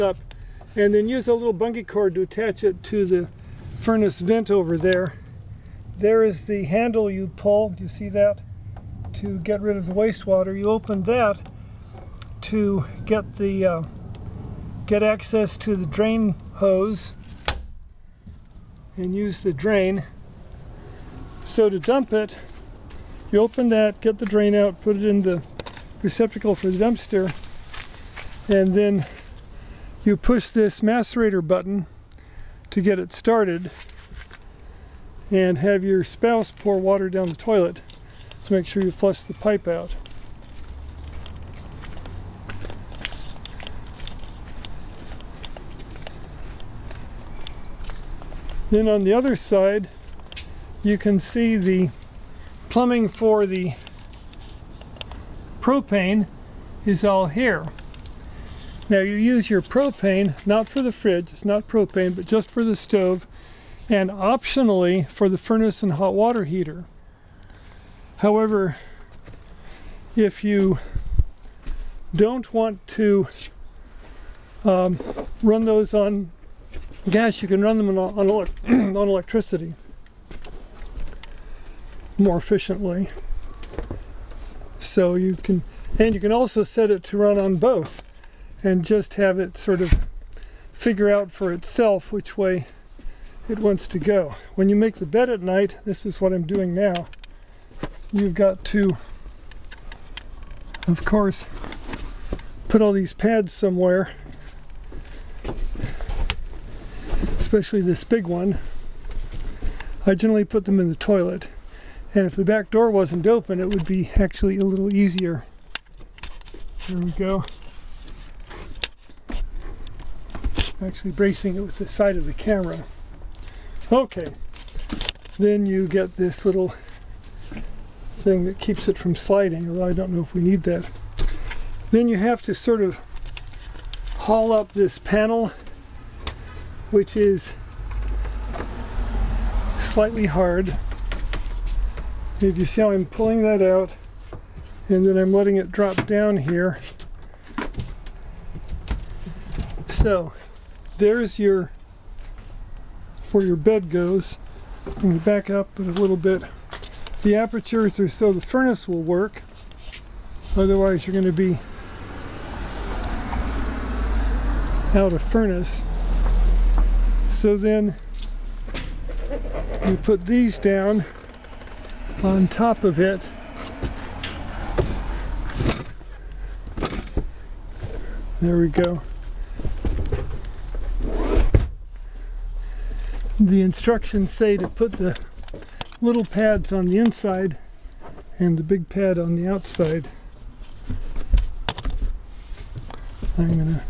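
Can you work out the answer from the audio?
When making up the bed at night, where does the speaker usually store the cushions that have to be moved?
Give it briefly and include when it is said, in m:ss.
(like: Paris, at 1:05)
in the toilet, at 1:50.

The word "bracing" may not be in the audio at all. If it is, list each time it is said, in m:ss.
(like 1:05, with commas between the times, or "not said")
2:01.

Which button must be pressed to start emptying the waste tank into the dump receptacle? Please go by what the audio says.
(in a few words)
macerator button.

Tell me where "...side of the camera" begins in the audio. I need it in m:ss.
2:01.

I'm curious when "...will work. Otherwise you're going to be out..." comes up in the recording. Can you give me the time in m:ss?
2:38.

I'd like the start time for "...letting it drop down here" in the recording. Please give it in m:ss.
2:25.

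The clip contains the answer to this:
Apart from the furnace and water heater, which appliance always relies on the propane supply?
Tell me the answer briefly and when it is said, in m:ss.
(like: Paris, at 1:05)
the stove, at 1:02.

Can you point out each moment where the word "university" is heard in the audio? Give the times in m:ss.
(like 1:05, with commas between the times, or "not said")
not said.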